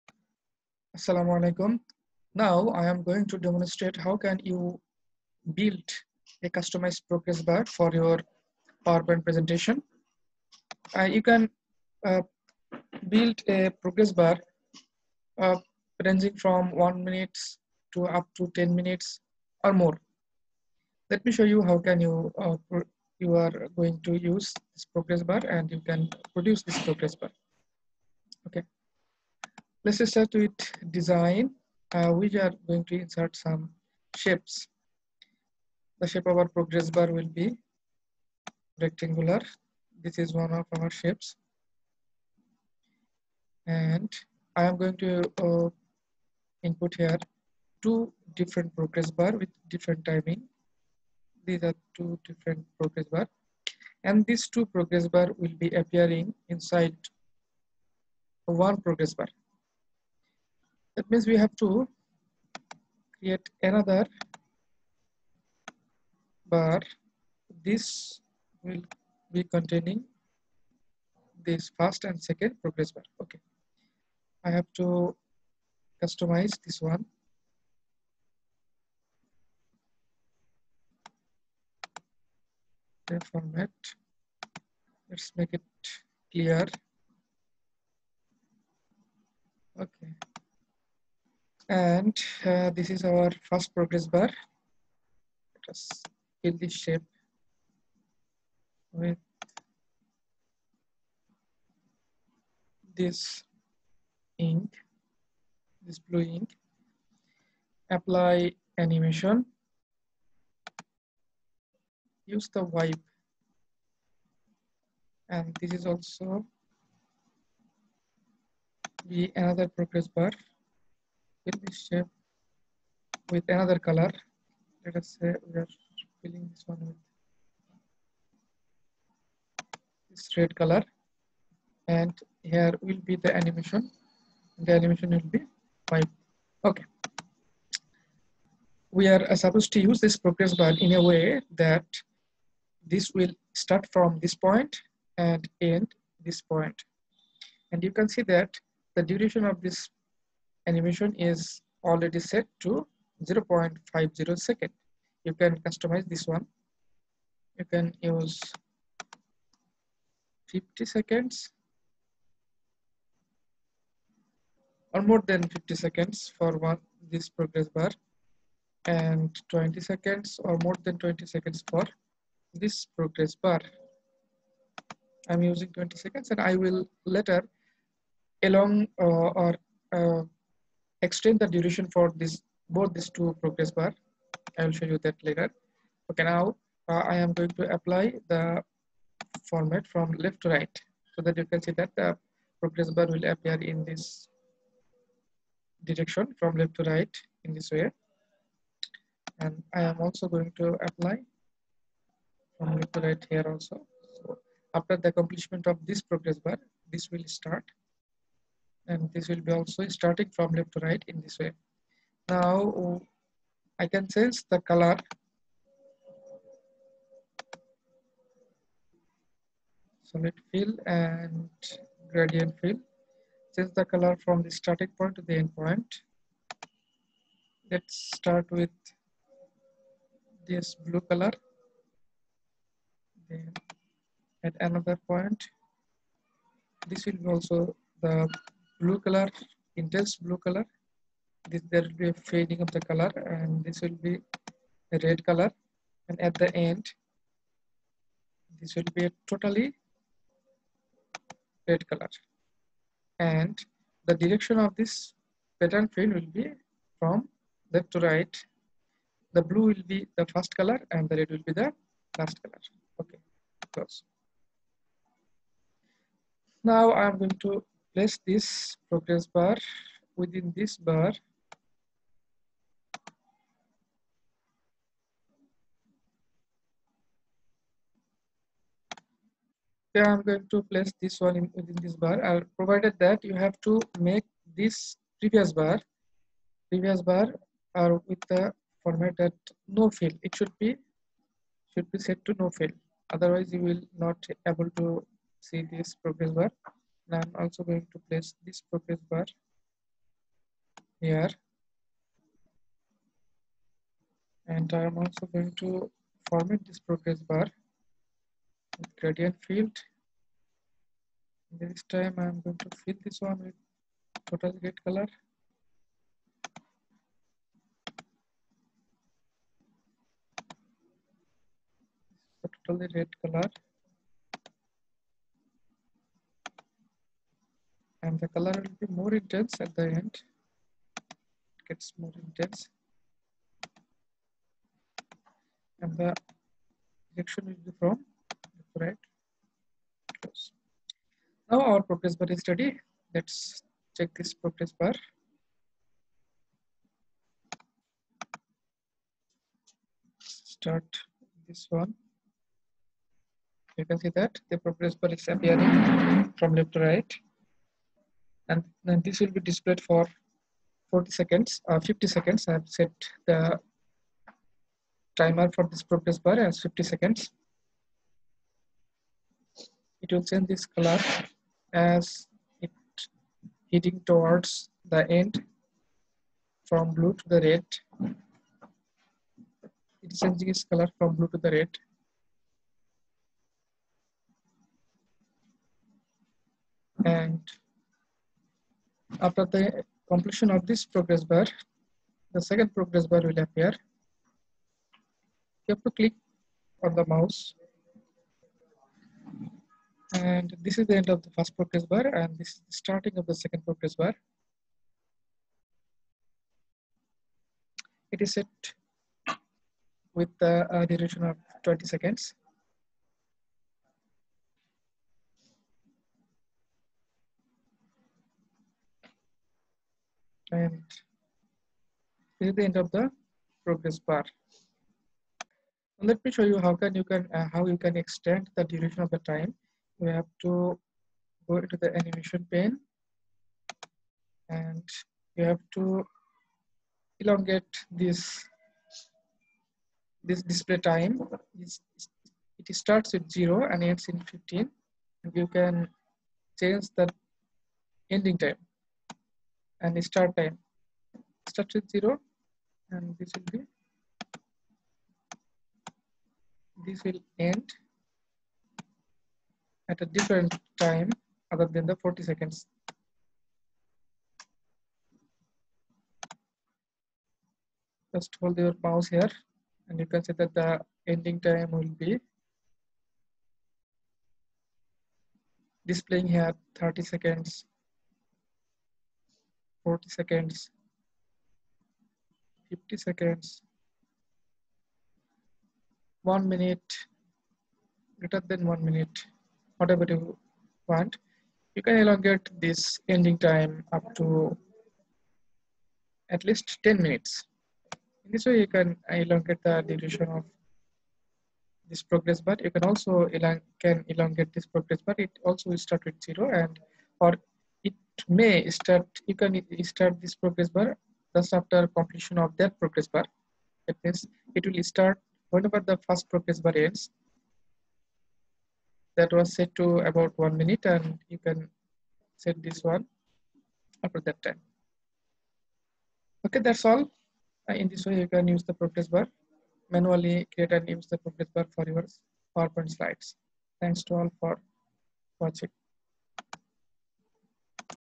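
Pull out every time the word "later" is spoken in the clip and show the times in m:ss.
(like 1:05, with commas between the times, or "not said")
2:57, 3:05.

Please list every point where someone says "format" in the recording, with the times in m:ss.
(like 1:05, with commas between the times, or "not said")
1:23, 3:09, 4:48, 5:06.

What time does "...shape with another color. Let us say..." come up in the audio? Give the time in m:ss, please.
2:01.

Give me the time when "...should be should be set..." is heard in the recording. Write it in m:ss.
4:50.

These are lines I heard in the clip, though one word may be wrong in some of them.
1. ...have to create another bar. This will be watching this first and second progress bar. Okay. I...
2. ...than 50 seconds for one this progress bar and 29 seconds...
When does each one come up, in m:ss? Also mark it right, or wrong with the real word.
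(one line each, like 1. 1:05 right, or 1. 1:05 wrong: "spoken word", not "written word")
1. 1:01 wrong: "containing", not "watching"
2. 2:45 wrong: "20", not "29".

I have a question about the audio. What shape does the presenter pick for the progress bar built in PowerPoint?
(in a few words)
Rectangular.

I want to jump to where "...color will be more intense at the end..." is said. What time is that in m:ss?
5:28.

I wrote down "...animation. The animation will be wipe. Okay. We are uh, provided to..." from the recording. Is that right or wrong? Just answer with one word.
wrong.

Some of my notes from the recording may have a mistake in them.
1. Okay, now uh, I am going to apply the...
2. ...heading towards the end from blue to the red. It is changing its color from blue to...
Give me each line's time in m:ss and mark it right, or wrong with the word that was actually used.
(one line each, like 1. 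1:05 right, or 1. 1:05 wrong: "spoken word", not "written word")
1. 3:06 right
2. 6:13 right.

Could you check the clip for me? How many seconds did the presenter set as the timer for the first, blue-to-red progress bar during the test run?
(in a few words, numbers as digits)
50 seconds.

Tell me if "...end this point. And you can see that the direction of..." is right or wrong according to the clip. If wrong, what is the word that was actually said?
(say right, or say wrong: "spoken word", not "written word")
wrong: "duration", not "direction".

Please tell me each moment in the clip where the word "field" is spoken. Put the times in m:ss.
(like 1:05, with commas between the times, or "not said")
4:15.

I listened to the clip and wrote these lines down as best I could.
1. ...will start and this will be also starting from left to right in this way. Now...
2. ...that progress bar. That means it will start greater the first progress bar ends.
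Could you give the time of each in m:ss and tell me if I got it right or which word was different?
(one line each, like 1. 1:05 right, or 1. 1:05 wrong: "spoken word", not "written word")
1. 3:27 right
2. 8:32 wrong: "whenever", not "greater".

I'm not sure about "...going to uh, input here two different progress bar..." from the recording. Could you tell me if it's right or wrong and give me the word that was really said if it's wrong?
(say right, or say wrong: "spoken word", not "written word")
right.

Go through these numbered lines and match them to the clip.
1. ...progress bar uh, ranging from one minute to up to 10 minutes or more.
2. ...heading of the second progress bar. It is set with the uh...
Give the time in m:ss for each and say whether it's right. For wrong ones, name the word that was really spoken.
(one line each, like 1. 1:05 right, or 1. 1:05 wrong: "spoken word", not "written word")
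1. 0:13 right
2. 6:42 wrong: "starting", not "heading".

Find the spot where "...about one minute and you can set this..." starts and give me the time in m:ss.
8:39.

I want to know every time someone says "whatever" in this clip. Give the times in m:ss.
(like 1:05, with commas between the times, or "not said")
8:09.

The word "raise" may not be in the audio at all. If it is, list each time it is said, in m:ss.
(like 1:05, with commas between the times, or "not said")
not said.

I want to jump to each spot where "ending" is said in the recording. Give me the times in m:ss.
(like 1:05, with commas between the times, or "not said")
7:28, 7:51, 8:13.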